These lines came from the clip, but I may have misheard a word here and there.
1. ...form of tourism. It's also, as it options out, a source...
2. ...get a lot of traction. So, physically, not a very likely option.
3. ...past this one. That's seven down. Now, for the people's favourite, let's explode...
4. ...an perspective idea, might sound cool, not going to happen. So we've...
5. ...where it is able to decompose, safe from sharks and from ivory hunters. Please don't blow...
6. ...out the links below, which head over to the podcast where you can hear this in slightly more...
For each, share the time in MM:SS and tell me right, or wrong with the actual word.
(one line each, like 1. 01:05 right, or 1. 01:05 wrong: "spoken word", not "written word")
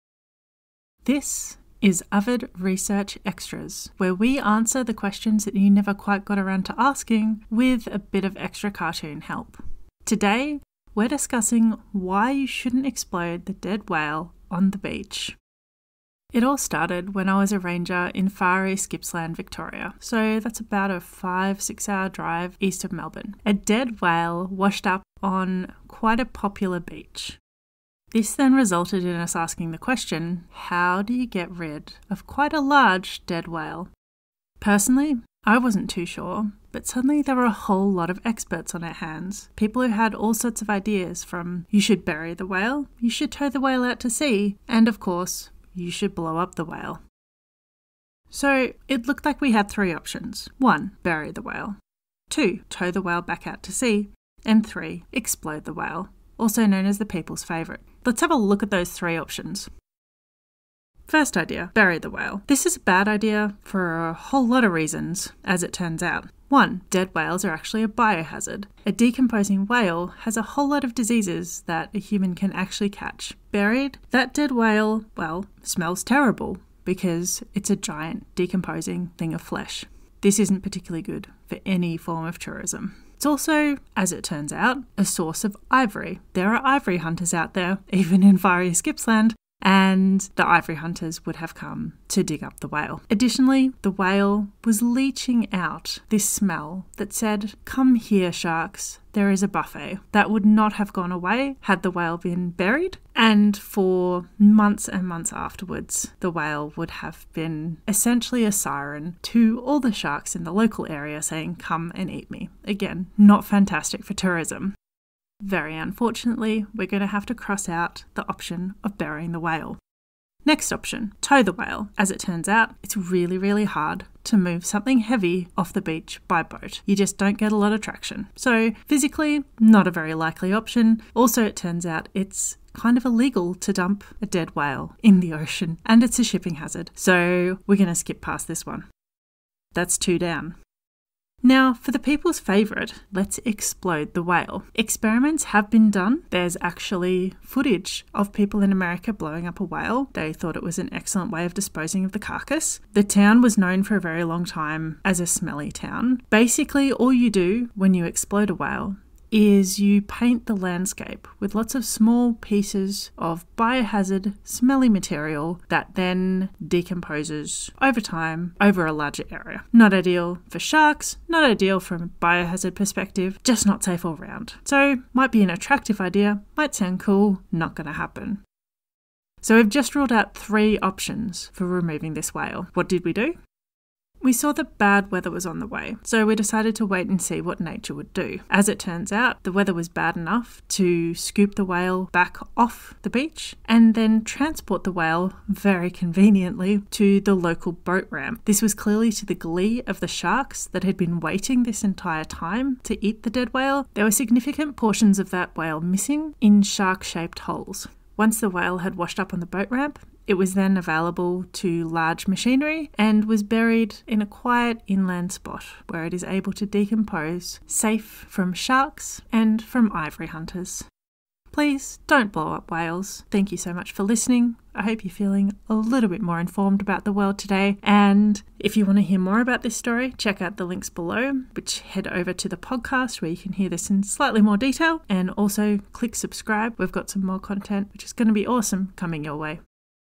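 1. 01:21 wrong: "turns", not "options"
2. 02:07 right
3. 02:18 wrong: "two", not "seven"
4. 02:55 wrong: "attractive", not "perspective"
5. 03:35 right
6. 03:50 right.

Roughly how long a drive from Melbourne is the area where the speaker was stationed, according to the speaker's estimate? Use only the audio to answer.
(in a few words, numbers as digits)
5-6 hours.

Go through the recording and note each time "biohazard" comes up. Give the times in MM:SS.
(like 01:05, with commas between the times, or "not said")
01:07, 02:43, 02:52.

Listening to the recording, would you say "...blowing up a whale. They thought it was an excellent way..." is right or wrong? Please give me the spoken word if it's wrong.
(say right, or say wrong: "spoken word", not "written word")
right.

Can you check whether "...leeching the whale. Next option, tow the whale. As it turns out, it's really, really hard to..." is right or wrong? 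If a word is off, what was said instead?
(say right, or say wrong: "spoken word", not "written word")
wrong: "burying", not "leeching".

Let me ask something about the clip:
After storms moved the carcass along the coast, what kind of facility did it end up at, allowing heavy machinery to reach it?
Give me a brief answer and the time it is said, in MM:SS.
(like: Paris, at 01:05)
Local boat ramp, at 03:17.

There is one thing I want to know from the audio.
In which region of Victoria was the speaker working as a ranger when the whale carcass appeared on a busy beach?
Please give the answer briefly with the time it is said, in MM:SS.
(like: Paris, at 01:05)
Far east Gippsland, at 00:18.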